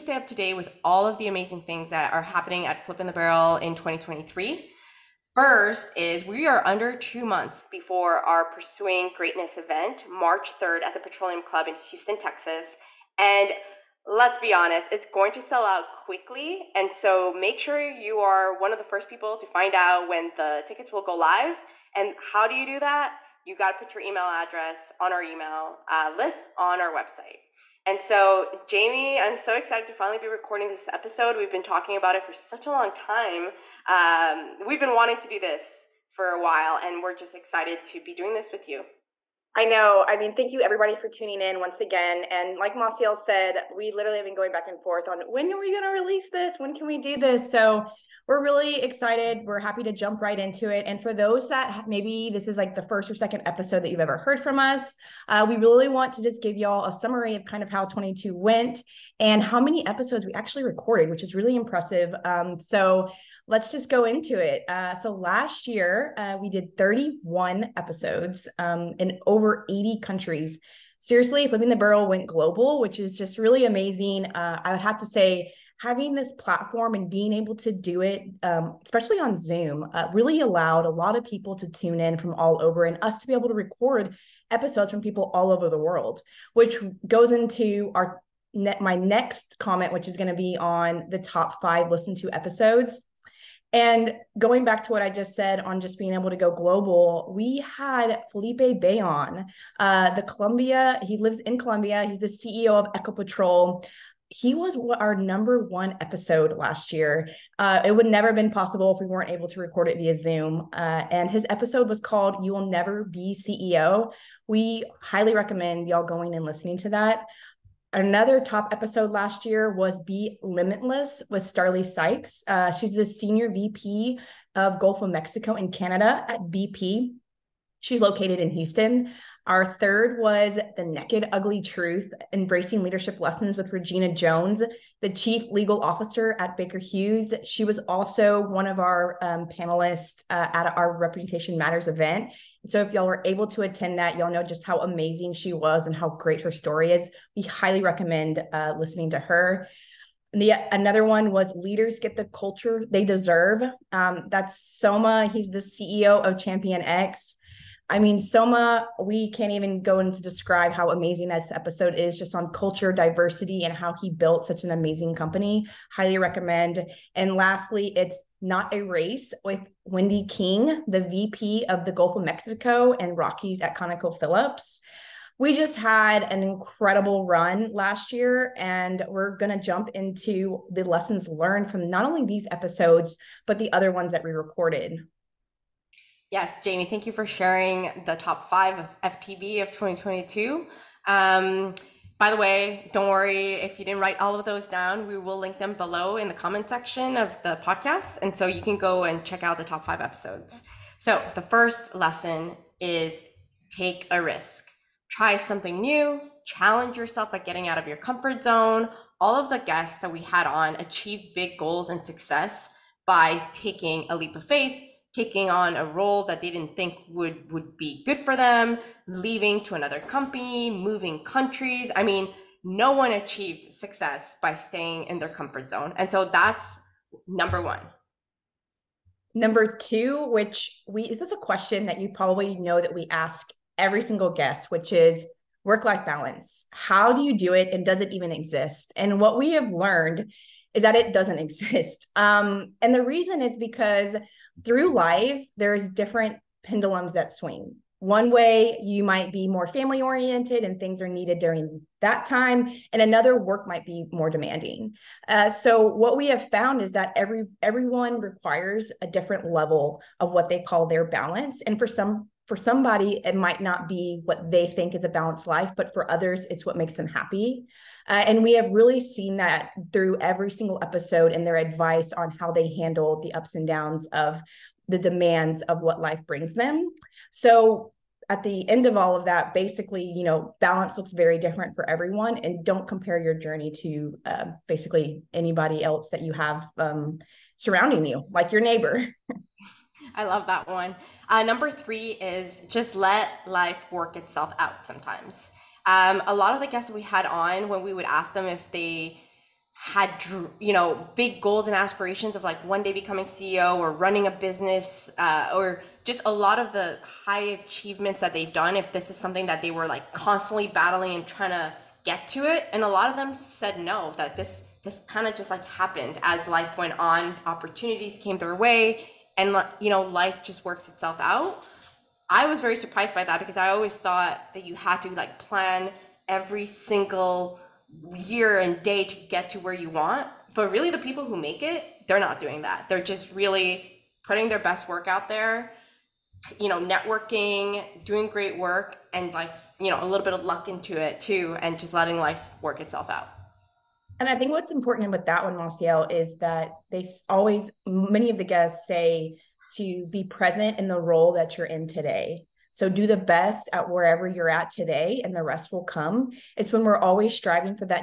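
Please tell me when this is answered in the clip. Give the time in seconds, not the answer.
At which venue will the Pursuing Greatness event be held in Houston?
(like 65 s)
10 s.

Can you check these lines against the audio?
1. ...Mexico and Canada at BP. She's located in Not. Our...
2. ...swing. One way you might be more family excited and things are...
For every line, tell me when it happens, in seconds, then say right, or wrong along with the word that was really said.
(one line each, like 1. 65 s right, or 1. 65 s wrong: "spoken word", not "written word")
1. 125 s wrong: "Houston", not "Not"
2. 247 s wrong: "oriented", not "excited".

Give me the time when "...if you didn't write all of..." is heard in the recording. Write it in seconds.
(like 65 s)
193 s.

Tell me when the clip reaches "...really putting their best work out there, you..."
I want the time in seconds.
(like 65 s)
333 s.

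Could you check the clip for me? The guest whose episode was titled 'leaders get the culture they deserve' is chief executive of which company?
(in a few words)
ChampionX.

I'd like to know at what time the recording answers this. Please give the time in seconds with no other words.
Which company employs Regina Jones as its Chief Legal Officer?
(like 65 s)
136 s.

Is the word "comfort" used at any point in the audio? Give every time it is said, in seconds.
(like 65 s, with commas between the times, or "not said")
207 s, 225 s.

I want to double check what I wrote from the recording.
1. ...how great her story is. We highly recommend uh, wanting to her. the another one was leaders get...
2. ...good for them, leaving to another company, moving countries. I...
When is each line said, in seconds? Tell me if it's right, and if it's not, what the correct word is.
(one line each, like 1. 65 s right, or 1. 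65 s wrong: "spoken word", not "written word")
1. 145 s wrong: "listening", not "wanting"
2. 218 s right.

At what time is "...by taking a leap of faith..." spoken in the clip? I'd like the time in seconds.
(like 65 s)
213 s.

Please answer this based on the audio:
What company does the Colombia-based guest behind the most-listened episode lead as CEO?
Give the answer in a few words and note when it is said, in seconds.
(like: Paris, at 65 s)
Ecopetrol, at 102 s.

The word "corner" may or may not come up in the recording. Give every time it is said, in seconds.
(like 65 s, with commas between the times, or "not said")
not said.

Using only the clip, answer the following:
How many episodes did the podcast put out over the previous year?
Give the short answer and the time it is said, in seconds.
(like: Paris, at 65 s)
31, at 66 s.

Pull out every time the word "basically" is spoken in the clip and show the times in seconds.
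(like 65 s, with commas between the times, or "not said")
279 s, 284 s.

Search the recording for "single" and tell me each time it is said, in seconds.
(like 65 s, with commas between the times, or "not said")
234 s, 270 s, 326 s.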